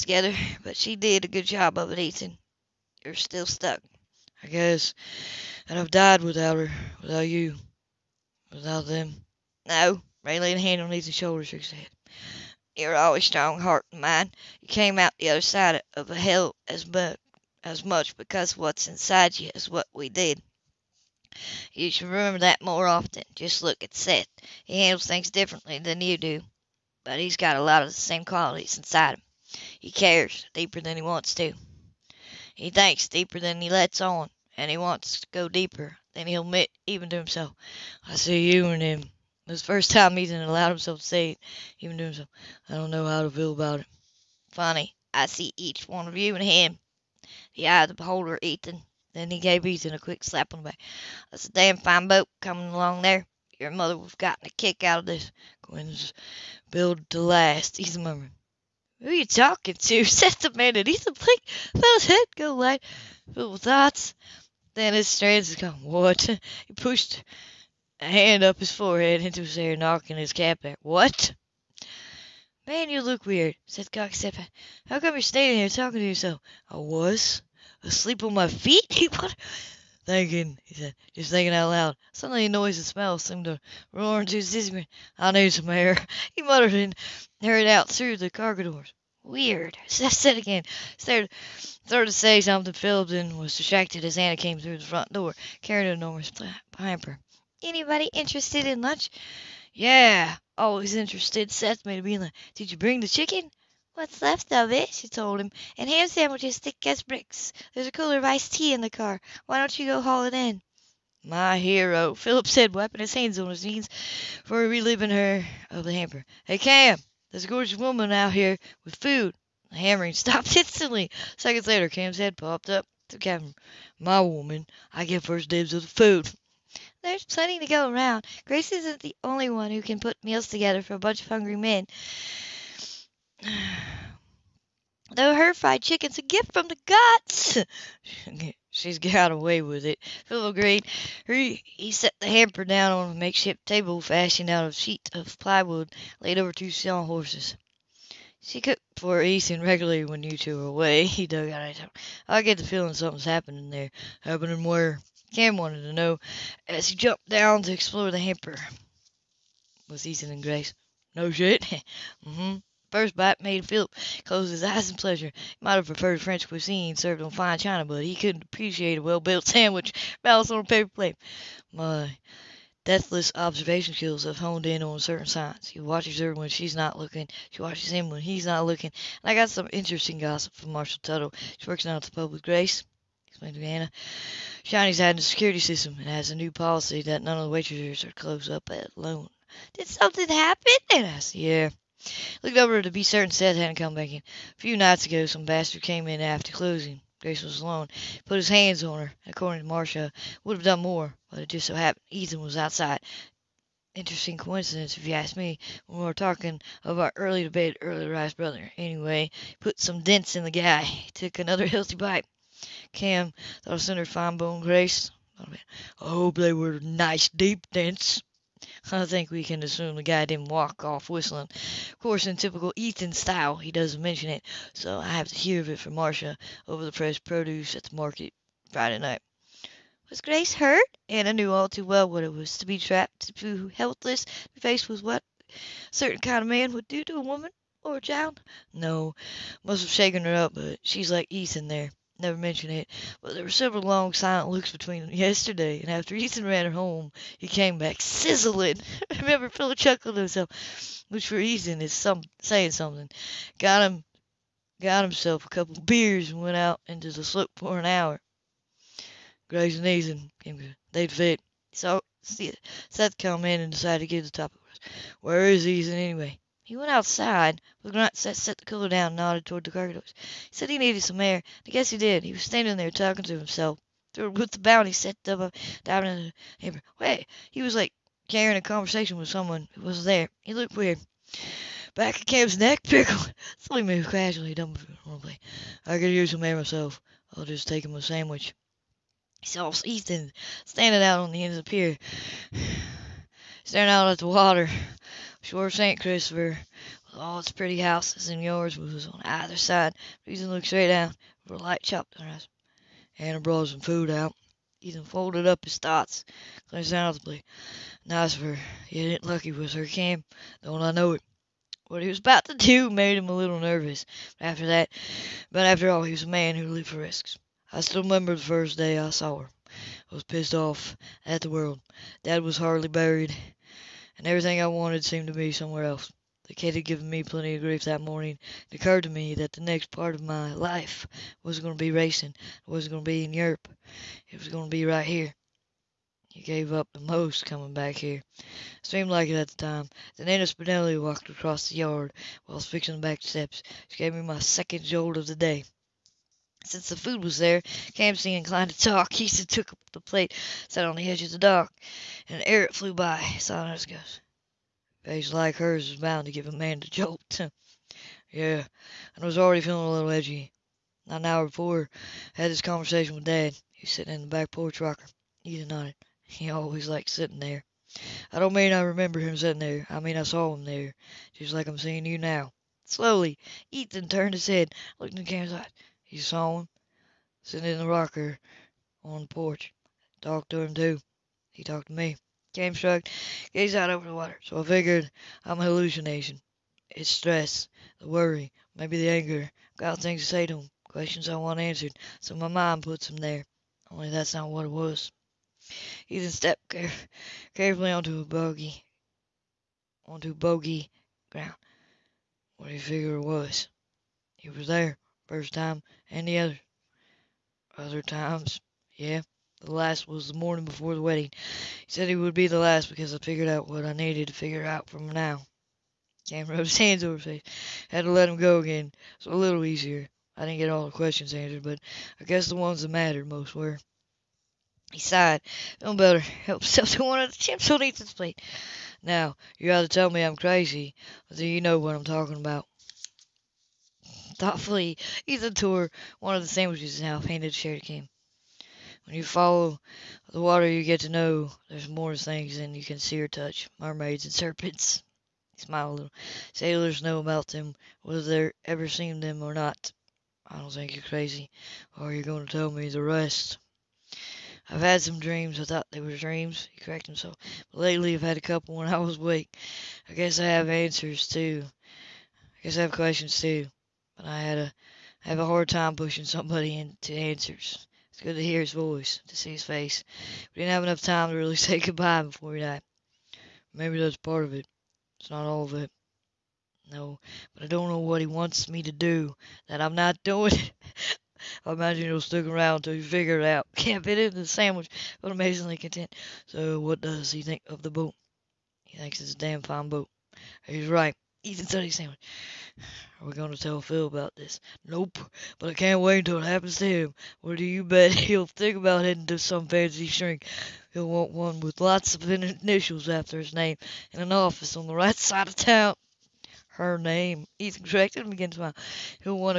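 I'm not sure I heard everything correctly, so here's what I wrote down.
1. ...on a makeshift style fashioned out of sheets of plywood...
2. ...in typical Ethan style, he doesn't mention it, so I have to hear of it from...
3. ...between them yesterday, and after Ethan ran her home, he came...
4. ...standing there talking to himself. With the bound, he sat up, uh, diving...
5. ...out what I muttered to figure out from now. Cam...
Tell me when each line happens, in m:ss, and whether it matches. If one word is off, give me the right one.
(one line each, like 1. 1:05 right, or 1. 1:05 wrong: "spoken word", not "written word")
1. 2:22 wrong: "table", not "style"
2. 3:42 right
3. 4:04 right
4. 4:32 right
5. 6:53 wrong: "needed", not "muttered".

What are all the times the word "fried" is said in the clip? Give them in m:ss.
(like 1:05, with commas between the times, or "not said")
2:15.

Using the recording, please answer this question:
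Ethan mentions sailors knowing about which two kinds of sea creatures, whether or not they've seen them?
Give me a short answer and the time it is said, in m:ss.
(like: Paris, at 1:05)
mermaids and serpents, at 7:23.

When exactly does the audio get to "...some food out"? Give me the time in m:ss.
5:03.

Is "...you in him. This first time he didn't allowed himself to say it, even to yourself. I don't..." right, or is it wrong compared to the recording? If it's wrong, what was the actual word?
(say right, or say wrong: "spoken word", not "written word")
wrong: "himself", not "yourself".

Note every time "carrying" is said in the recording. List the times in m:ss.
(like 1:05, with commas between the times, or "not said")
1:35, 4:38.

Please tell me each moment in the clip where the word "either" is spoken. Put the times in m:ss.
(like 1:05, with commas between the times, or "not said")
4:59, 7:09.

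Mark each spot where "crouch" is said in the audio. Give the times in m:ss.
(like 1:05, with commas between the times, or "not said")
not said.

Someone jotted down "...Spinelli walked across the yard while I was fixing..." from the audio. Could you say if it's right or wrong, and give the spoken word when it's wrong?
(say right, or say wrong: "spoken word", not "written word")
right.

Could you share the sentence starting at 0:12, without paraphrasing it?
You're always strong heart and mind.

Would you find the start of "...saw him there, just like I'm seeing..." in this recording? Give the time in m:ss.
6:10.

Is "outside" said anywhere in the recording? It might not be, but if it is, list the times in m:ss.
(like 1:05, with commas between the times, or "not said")
3:22, 4:26.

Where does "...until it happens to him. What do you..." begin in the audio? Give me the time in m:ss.
8:16.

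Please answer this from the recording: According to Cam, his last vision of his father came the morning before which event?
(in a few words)
the wedding.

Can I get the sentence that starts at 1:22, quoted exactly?
Suddenly a noise and smell seemed to roar into his ears.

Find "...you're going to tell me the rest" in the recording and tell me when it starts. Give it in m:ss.
7:32.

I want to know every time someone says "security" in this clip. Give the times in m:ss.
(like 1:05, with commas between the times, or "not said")
3:05.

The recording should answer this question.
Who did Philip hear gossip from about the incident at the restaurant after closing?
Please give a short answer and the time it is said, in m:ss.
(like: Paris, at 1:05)
Marcia Tuttle, at 3:00.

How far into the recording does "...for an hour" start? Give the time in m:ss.
4:17.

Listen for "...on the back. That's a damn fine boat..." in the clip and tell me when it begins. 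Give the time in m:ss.
0:50.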